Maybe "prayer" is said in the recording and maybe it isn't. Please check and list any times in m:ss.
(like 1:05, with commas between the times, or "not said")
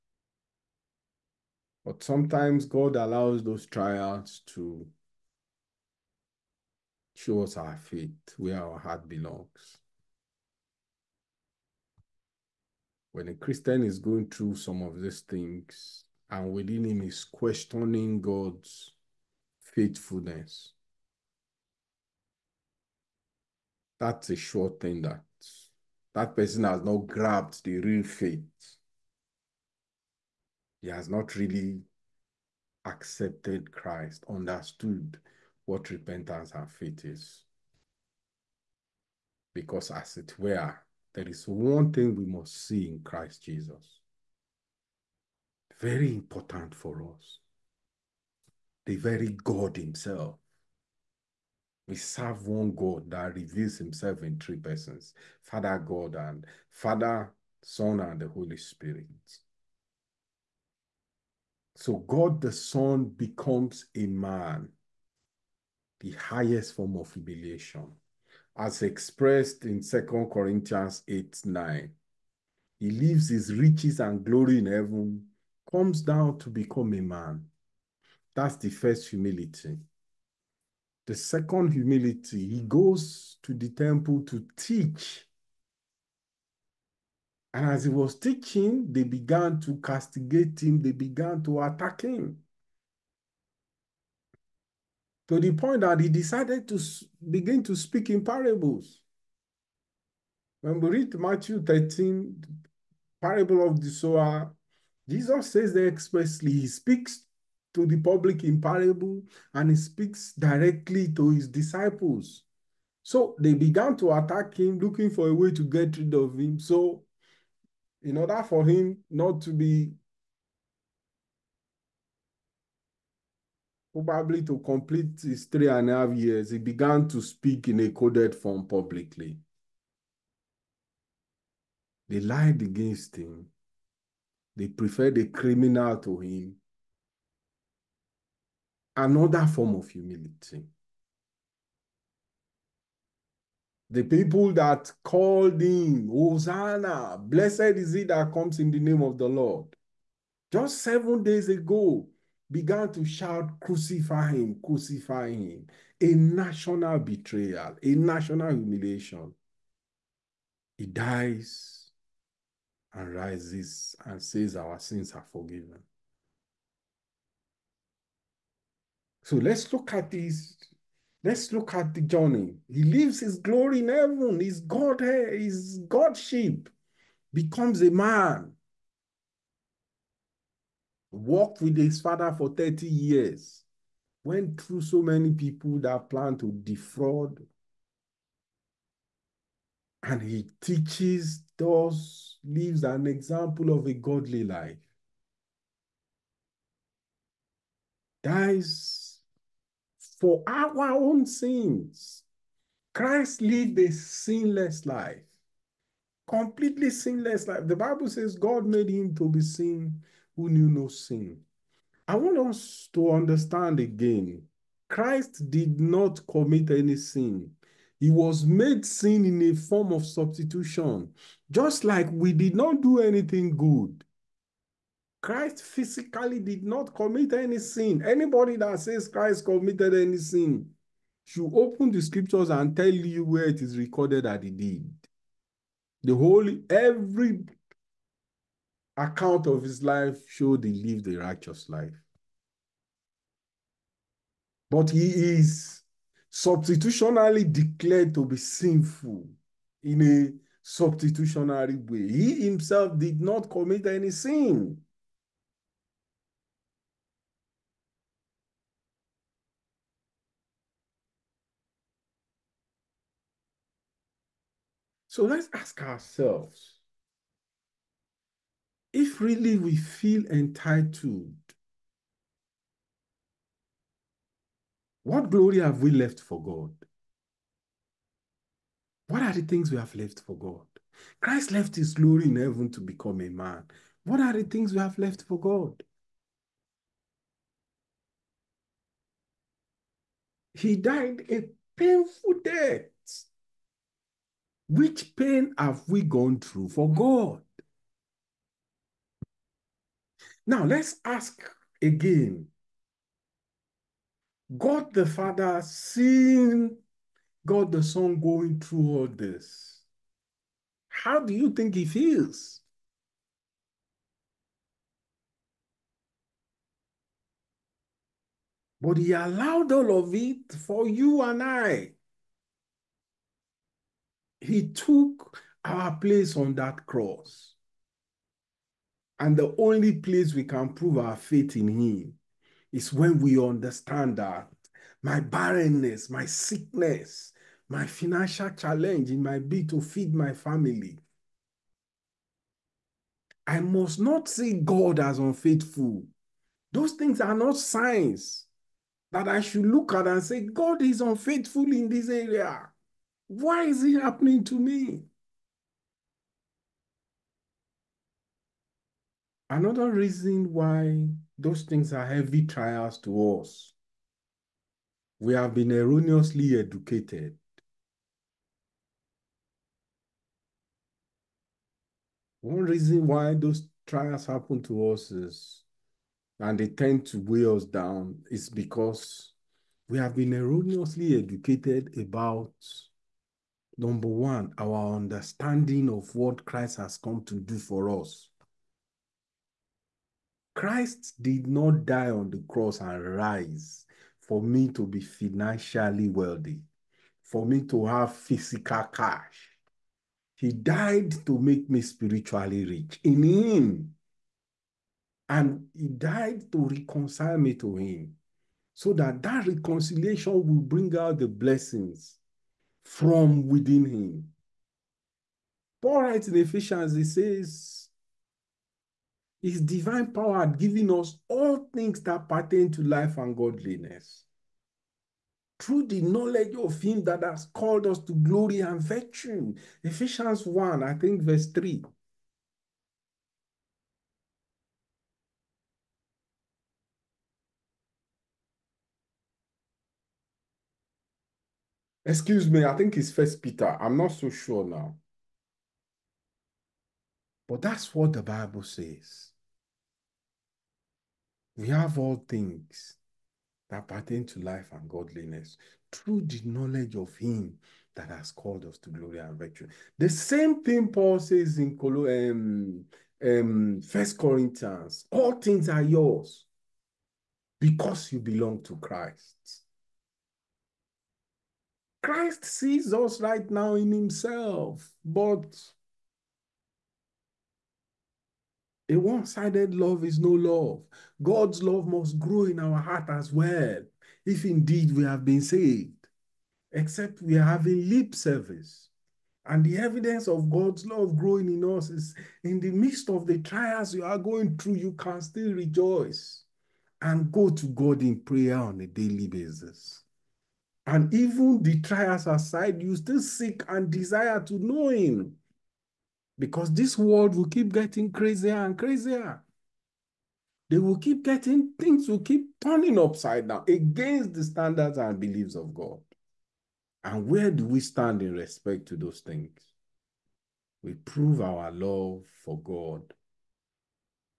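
8:18.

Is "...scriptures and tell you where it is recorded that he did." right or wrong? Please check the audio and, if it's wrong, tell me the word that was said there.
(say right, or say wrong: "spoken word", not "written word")
right.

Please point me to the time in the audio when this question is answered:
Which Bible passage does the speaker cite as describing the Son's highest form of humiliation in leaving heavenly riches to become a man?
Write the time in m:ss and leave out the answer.
1:09.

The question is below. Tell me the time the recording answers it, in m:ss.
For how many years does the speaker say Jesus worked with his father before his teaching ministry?
3:02.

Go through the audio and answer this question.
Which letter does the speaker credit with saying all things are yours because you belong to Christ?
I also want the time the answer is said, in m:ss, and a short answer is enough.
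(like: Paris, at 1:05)
First Corinthians, at 7:43.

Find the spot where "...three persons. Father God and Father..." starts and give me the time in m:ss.
0:54.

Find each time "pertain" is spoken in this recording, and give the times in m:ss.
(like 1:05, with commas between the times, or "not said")
7:02, 7:33.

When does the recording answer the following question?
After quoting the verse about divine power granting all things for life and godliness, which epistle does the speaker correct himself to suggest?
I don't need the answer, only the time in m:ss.
7:23.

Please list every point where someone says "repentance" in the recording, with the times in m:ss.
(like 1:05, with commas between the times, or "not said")
0:35.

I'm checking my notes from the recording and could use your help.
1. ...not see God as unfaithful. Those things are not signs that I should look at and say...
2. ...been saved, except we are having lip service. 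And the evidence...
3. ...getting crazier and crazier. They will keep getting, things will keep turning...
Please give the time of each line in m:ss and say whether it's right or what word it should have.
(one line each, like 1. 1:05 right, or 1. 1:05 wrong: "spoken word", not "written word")
1. 5:43 right
2. 8:05 right
3. 8:27 right.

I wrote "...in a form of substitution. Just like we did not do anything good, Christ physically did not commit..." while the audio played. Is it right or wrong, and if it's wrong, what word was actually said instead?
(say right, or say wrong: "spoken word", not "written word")
right.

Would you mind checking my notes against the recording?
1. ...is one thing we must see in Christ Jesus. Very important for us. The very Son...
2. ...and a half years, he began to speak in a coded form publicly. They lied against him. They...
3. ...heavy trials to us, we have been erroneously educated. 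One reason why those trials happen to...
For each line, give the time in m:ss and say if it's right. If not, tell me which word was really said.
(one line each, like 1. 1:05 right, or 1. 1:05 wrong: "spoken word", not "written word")
1. 0:41 wrong: "God", not "Son"
2. 2:05 right
3. 6:02 right.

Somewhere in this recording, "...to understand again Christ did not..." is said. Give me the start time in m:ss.
3:32.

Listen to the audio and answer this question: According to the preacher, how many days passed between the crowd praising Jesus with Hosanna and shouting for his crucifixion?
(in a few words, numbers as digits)
seven days.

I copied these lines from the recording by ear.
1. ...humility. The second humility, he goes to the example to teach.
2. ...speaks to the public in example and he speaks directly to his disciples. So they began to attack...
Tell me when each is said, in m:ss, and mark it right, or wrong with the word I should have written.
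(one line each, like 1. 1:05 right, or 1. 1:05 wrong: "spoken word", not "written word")
1. 1:19 wrong: "temple", not "example"
2. 1:46 wrong: "parable", not "example".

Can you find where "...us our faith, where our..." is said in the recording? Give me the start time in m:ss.
0:07.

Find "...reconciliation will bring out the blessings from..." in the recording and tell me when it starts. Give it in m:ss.
6:49.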